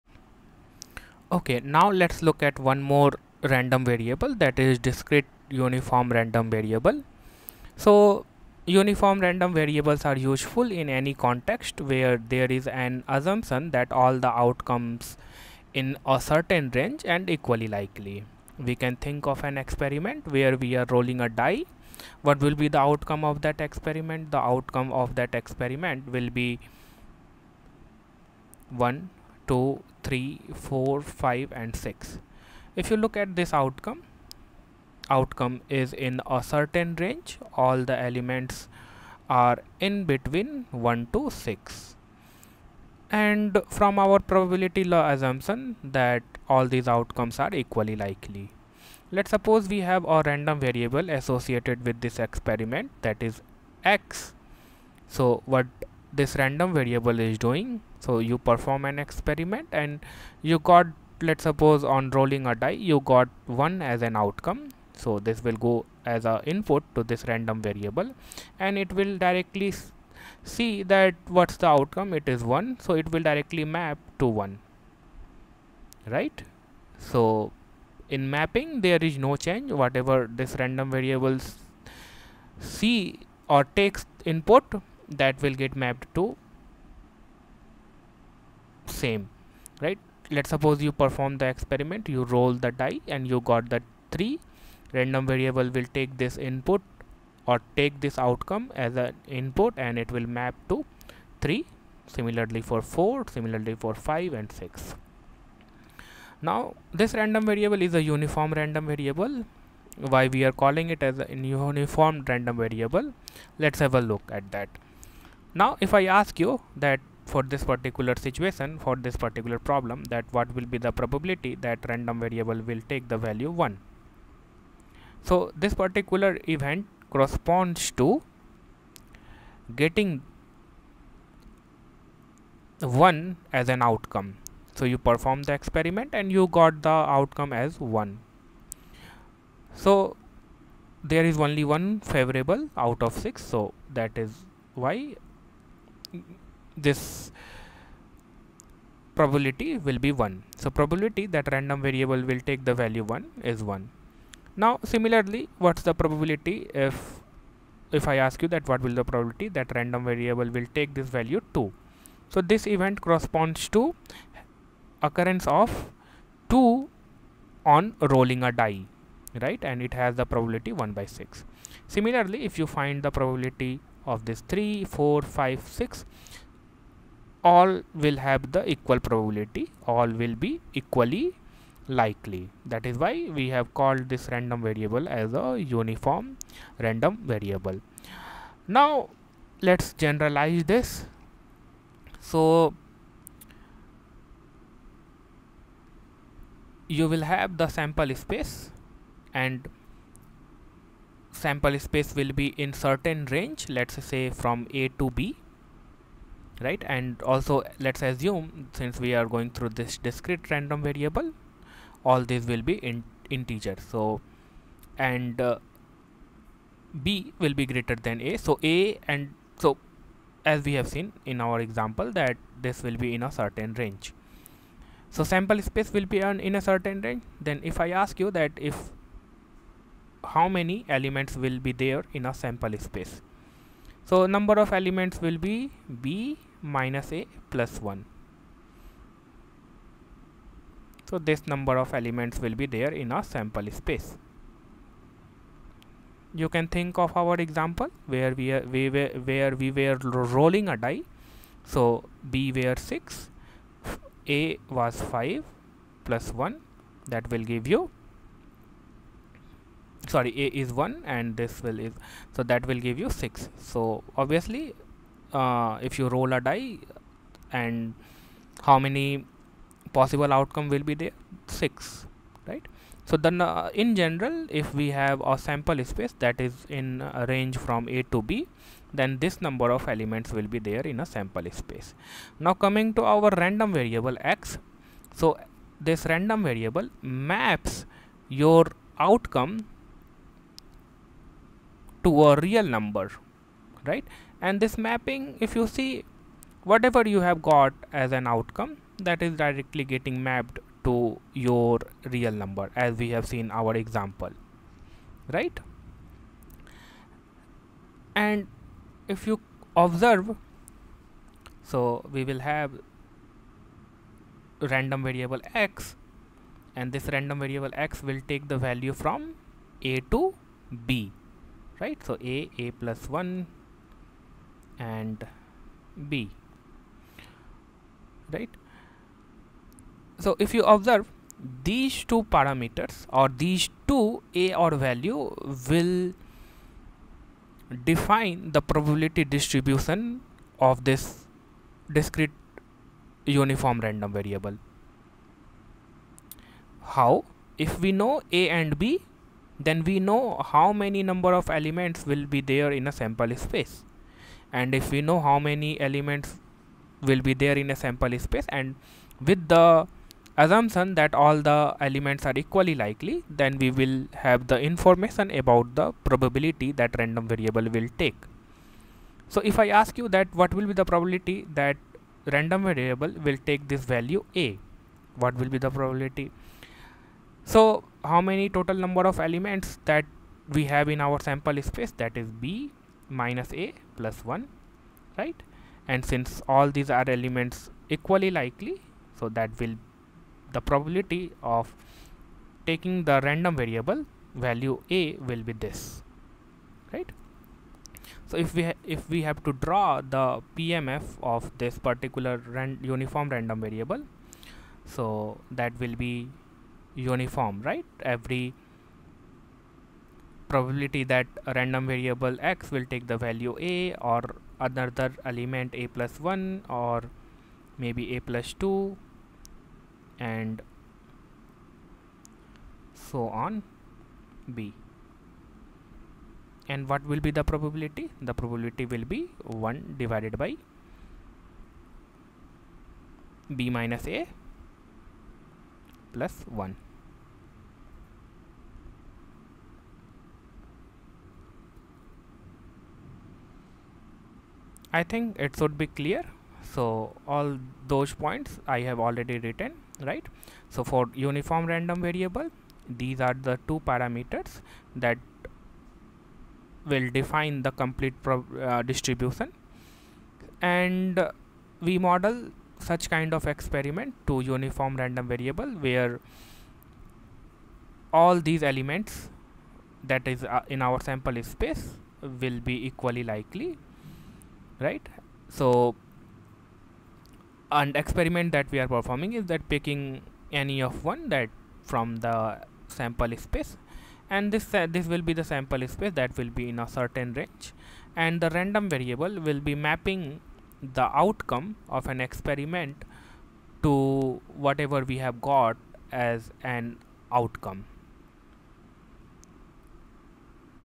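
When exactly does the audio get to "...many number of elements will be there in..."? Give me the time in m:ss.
5:50.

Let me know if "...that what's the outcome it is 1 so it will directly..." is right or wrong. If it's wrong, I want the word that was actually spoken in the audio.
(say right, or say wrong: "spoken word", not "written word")
right.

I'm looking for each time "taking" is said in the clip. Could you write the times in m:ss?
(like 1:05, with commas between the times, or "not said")
6:32.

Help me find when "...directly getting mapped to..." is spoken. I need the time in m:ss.
4:59.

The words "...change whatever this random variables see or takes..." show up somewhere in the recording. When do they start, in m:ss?
1:19.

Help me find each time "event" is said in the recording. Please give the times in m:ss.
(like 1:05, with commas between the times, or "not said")
2:06, 2:42.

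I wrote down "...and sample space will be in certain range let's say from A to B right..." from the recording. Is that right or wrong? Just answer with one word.
right.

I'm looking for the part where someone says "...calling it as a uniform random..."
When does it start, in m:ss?
1:50.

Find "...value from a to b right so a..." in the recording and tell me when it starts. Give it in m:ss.
5:18.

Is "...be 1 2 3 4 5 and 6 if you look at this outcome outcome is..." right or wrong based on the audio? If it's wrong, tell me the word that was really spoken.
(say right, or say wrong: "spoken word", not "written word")
right.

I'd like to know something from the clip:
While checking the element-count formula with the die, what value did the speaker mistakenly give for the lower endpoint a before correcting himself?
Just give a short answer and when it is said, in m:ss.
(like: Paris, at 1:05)
5, at 4:14.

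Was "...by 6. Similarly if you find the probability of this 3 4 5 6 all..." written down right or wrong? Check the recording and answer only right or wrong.
right.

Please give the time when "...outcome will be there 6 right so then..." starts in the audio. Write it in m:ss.
4:30.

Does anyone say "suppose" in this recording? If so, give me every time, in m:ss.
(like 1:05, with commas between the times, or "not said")
0:49, 1:01, 1:30.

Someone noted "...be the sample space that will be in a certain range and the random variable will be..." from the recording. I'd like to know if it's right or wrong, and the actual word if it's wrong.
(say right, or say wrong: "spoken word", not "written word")
right.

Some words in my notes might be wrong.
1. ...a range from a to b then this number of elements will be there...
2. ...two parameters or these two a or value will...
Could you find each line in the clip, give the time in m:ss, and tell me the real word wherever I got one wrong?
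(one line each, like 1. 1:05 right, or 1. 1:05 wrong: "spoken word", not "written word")
1. 4:37 right
2. 5:32 right.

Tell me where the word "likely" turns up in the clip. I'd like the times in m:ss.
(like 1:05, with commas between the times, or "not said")
0:17, 0:47, 3:01, 6:02, 6:28, 7:53.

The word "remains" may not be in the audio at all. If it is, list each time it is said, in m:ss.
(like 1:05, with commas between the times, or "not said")
not said.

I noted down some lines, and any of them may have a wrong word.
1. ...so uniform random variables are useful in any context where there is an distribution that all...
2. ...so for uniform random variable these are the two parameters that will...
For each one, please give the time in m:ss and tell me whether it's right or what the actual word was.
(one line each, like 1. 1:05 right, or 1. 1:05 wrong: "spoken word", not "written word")
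1. 0:07 wrong: "assumption", not "distribution"
2. 7:30 right.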